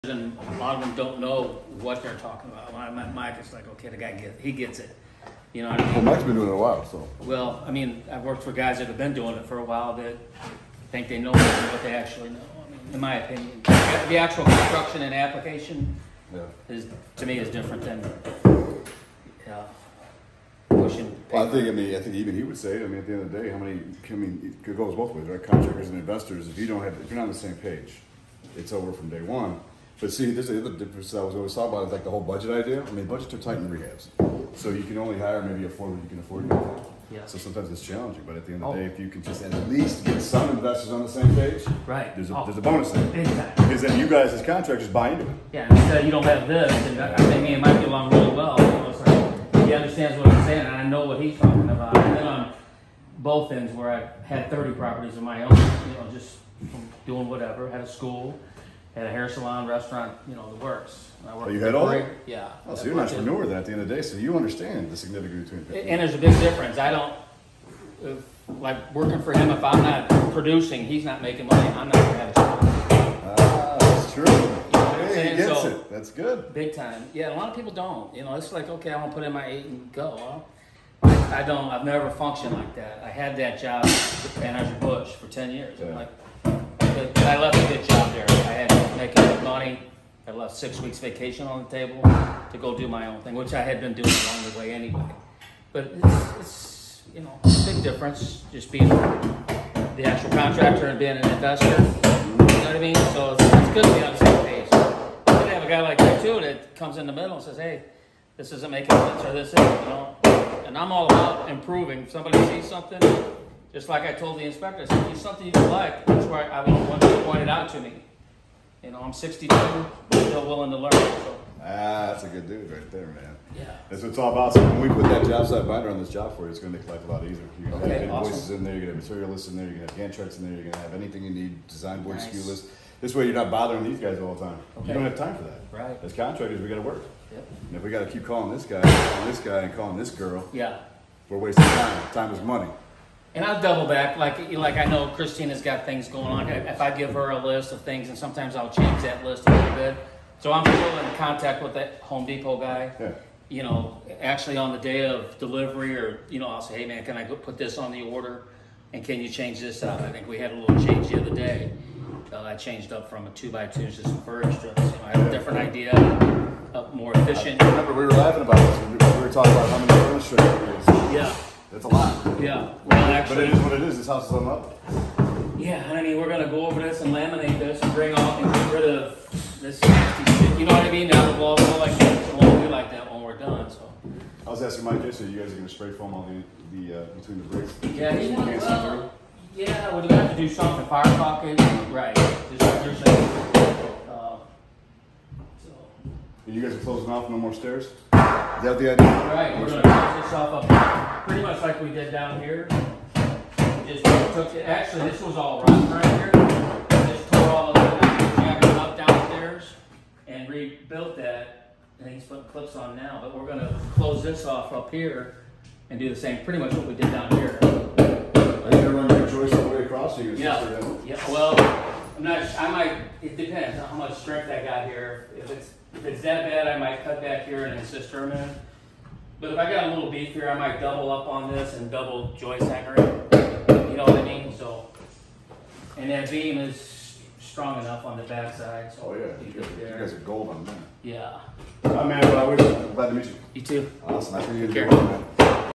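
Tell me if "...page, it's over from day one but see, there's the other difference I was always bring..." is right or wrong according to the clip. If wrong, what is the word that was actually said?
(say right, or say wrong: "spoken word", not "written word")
wrong: "talking", not "bring".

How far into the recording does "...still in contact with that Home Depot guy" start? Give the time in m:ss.
2:30.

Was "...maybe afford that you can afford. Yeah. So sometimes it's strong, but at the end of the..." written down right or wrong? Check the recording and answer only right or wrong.
wrong.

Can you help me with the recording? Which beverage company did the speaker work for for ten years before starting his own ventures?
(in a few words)
Anheuser-Busch.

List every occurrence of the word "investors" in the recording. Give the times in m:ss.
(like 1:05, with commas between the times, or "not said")
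0:25, 0:40, 1:41.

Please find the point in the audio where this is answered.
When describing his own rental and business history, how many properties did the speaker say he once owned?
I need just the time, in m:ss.
0:54.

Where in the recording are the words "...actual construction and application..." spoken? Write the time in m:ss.
0:14.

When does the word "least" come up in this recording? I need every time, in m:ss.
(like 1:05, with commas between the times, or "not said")
0:39.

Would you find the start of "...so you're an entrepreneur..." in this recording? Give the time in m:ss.
1:02.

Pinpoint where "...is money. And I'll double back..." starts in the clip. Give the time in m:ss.
2:22.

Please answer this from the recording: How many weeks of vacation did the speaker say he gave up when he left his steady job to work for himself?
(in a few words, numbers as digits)
6.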